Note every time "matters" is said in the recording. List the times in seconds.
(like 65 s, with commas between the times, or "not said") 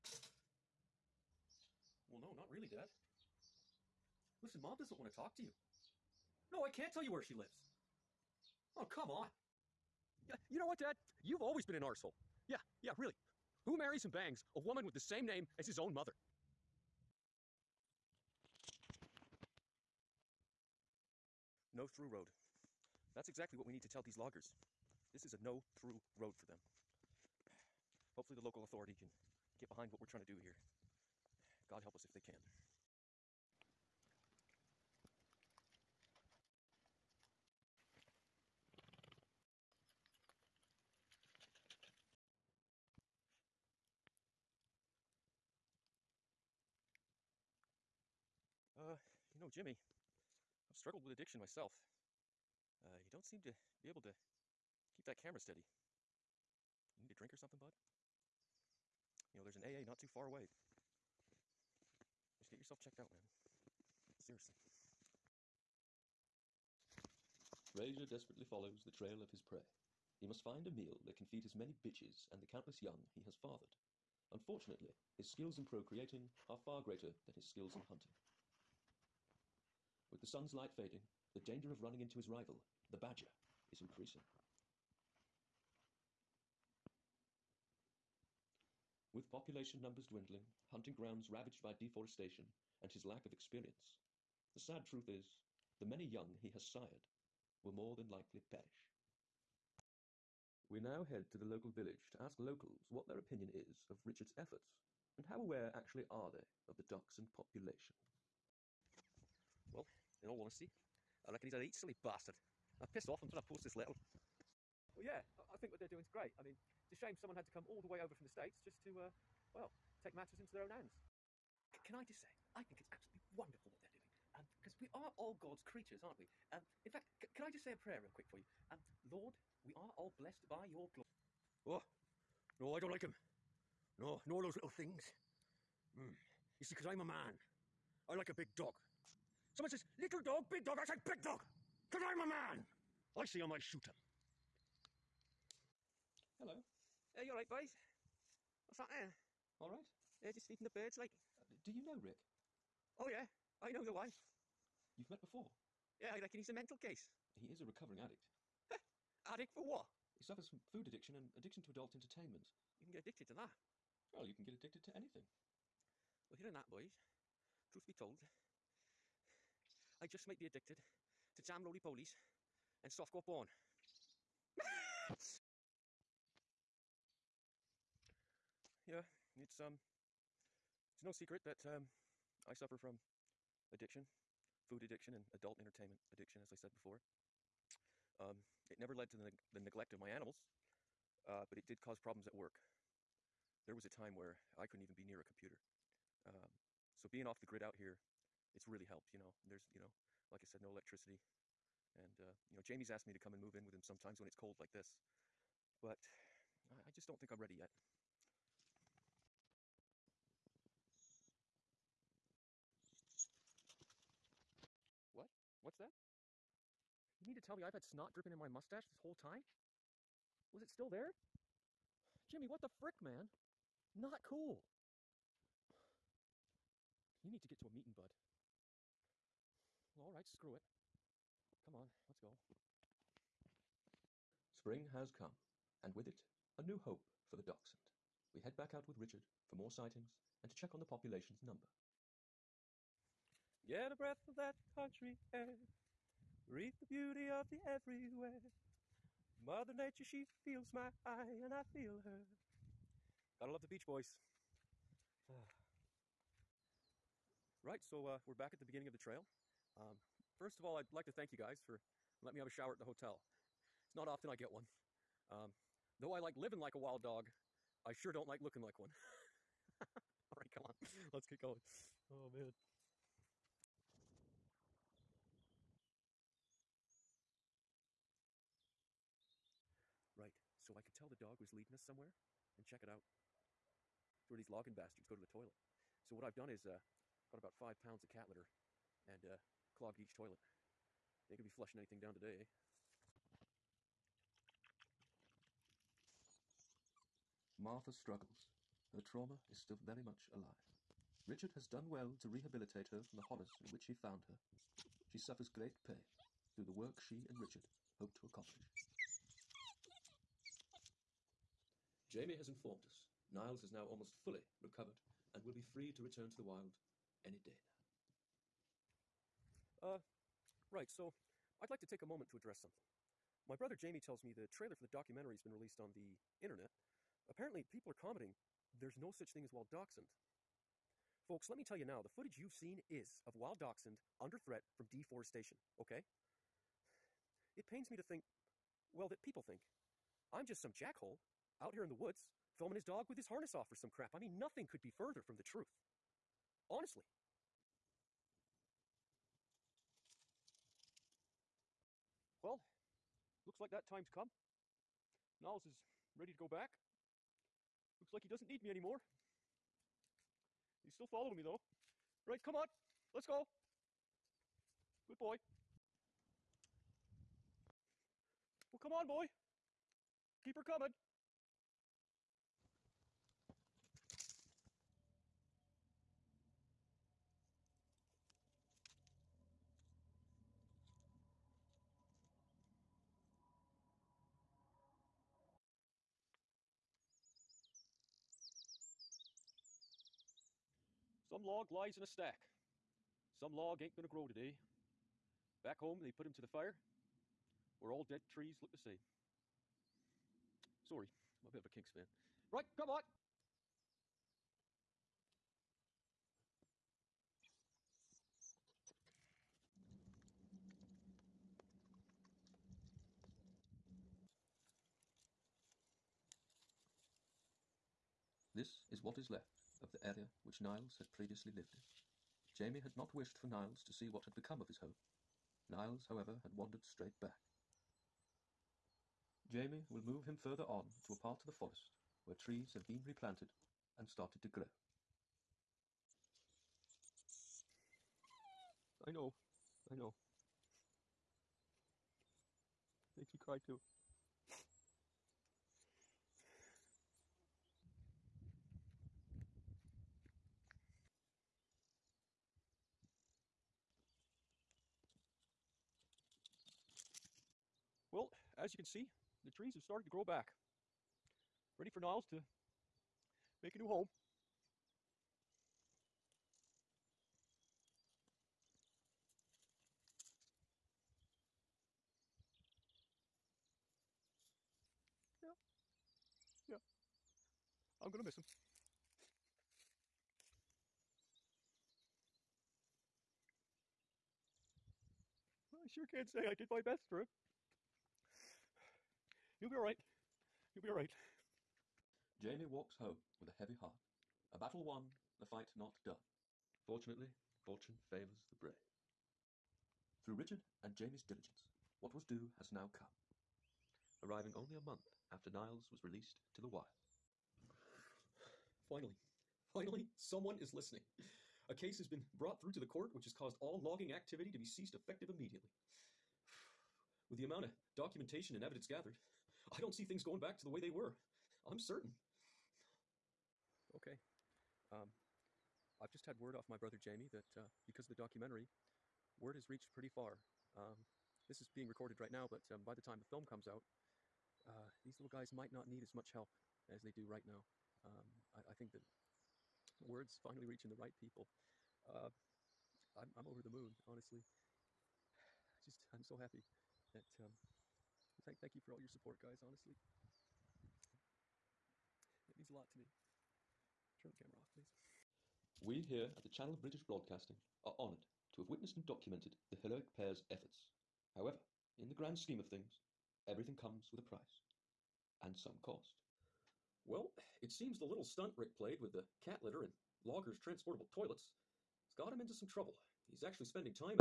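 120 s.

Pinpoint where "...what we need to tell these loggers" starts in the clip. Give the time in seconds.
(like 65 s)
23 s.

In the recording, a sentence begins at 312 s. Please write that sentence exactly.
Jamie has informed us Niles is now almost fully recovered and will be free to return to the wild any day now.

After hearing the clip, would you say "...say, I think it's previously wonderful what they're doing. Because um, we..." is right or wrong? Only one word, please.
wrong.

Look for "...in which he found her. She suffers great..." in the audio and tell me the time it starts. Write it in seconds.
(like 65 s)
303 s.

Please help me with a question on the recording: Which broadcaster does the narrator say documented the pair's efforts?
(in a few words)
Channel of British Broadcasting.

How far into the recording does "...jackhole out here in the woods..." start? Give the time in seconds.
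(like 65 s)
340 s.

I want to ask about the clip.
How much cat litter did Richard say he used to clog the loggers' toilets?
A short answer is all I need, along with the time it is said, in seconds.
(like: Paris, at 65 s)
5 pounds, at 287 s.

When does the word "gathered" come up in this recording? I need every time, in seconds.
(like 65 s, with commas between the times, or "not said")
518 s.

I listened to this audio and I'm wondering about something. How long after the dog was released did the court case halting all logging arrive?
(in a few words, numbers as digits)
A month.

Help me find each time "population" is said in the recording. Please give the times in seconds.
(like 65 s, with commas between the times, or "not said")
89 s, 107 s, 240 s.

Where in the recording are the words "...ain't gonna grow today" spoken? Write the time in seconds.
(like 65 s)
393 s.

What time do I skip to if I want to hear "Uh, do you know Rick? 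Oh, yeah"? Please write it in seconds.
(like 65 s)
151 s.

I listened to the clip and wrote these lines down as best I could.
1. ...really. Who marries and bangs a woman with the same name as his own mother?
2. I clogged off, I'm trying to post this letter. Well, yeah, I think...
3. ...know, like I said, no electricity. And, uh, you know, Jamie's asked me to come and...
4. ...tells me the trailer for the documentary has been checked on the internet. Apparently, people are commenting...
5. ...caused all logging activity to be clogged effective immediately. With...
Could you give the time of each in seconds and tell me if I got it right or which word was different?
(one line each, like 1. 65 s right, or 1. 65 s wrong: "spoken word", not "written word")
1. 12 s right
2. 112 s wrong: "pissed", not "clogged"
3. 199 s right
4. 323 s wrong: "released", not "checked"
5. 513 s wrong: "ceased", not "clogged".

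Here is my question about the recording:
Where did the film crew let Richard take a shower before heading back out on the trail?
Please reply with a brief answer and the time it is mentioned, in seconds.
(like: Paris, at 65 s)
The hotel, at 262 s.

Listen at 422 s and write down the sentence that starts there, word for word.
Jamie had not wished for Niles to see what had become of his home.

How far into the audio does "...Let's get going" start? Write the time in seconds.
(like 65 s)
271 s.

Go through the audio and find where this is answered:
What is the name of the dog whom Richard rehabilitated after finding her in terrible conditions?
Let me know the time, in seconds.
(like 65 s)
297 s.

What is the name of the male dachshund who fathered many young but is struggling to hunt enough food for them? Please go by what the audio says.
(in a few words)
Frasier.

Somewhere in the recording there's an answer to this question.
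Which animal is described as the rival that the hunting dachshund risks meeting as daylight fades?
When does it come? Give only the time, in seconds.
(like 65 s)
82 s.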